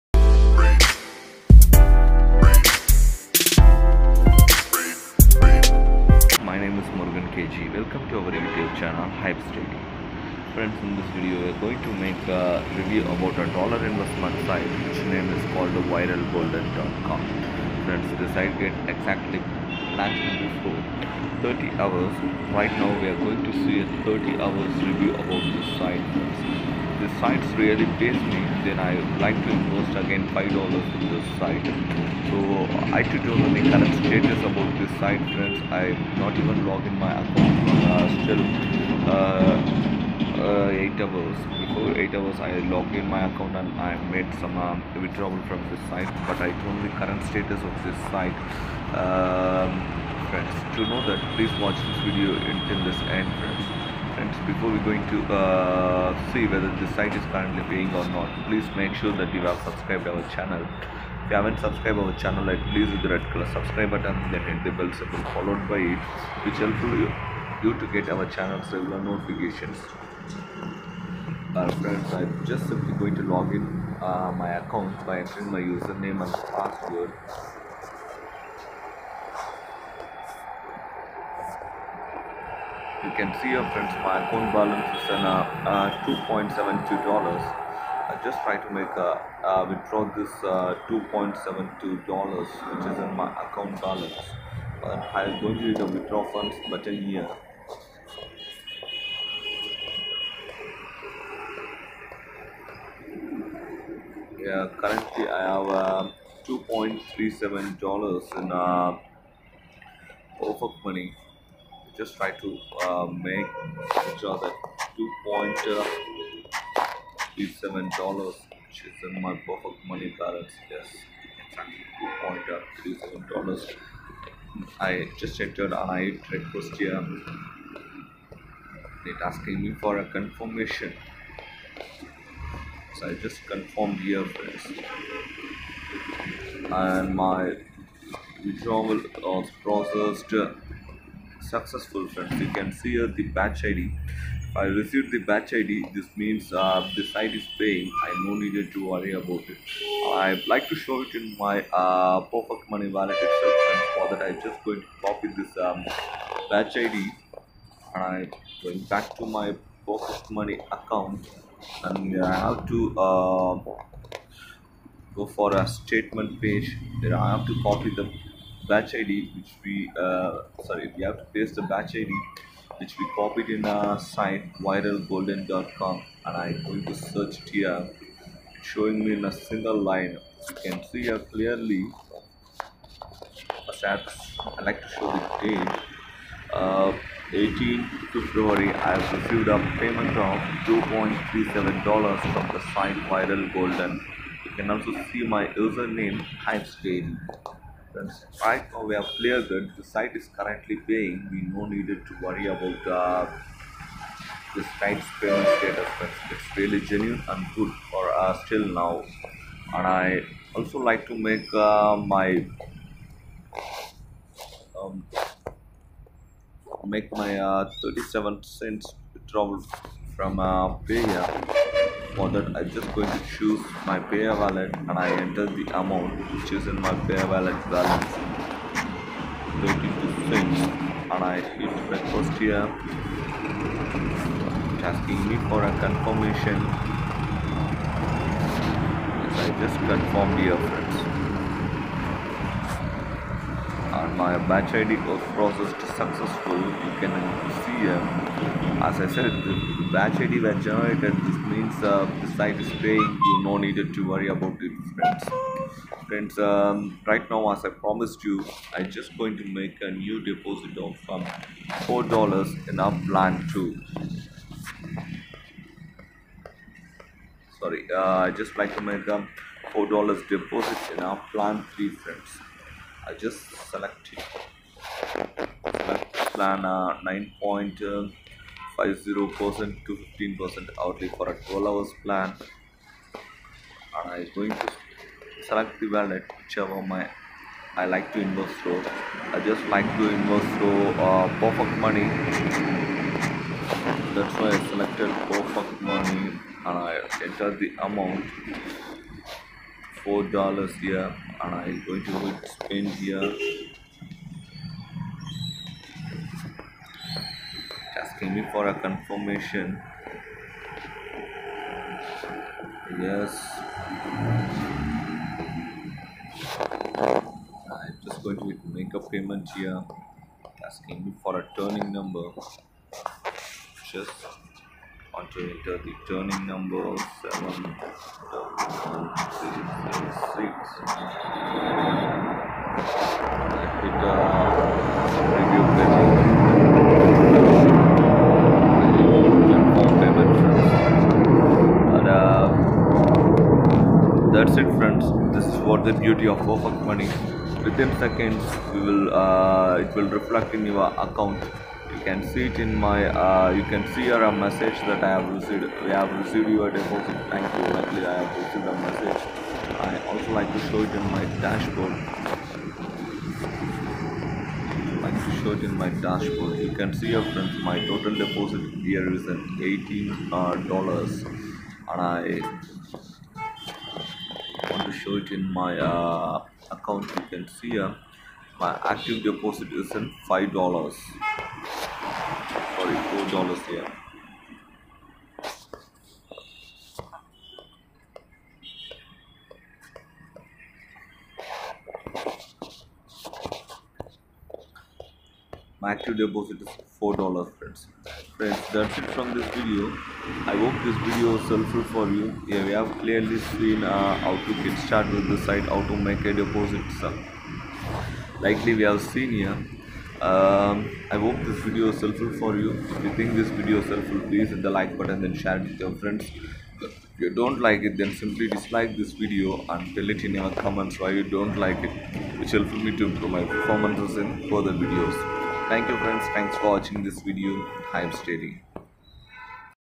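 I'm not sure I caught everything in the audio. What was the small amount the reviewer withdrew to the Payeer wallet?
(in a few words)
37 cents.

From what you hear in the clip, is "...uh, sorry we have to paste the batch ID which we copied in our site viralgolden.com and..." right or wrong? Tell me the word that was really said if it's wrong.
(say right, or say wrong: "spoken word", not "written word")
right.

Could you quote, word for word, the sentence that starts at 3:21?
We no needed to worry about uh, this site's payment status.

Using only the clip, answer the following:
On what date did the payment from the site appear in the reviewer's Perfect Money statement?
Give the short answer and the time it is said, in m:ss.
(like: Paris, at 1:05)
18 February, at 3:07.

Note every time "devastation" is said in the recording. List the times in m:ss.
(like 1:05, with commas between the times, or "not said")
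not said.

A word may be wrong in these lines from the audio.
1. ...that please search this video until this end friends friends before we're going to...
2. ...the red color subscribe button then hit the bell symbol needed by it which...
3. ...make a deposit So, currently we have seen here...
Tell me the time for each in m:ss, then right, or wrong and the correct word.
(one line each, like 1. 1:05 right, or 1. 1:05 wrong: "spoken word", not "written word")
1. 0:51 wrong: "watch", not "search"
2. 1:03 wrong: "followed", not "needed"
3. 6:46 wrong: "likely", not "currently".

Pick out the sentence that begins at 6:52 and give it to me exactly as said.
If you think this video is helpful, please hit the like button and share it with your friends.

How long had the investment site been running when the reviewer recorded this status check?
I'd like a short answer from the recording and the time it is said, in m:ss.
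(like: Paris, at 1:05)
30 hours, at 0:19.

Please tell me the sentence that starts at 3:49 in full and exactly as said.
Waiting to and I hit request here.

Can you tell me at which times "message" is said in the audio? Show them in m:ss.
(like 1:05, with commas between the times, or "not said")
5:54, 5:58.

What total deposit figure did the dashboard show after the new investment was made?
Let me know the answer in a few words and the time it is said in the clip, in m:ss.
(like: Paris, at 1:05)
$18, at 6:09.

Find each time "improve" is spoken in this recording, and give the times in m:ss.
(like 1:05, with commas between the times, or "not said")
7:03.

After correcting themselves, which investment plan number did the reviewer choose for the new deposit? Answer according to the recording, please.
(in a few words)
plan 3.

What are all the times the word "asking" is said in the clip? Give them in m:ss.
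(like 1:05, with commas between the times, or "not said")
2:09, 3:54, 5:08, 5:20.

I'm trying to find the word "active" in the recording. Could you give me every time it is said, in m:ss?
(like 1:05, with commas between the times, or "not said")
6:18, 6:35.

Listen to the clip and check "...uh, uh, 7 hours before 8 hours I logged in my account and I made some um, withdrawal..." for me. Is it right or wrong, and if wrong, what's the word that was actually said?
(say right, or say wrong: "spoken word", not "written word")
wrong: "8", not "7".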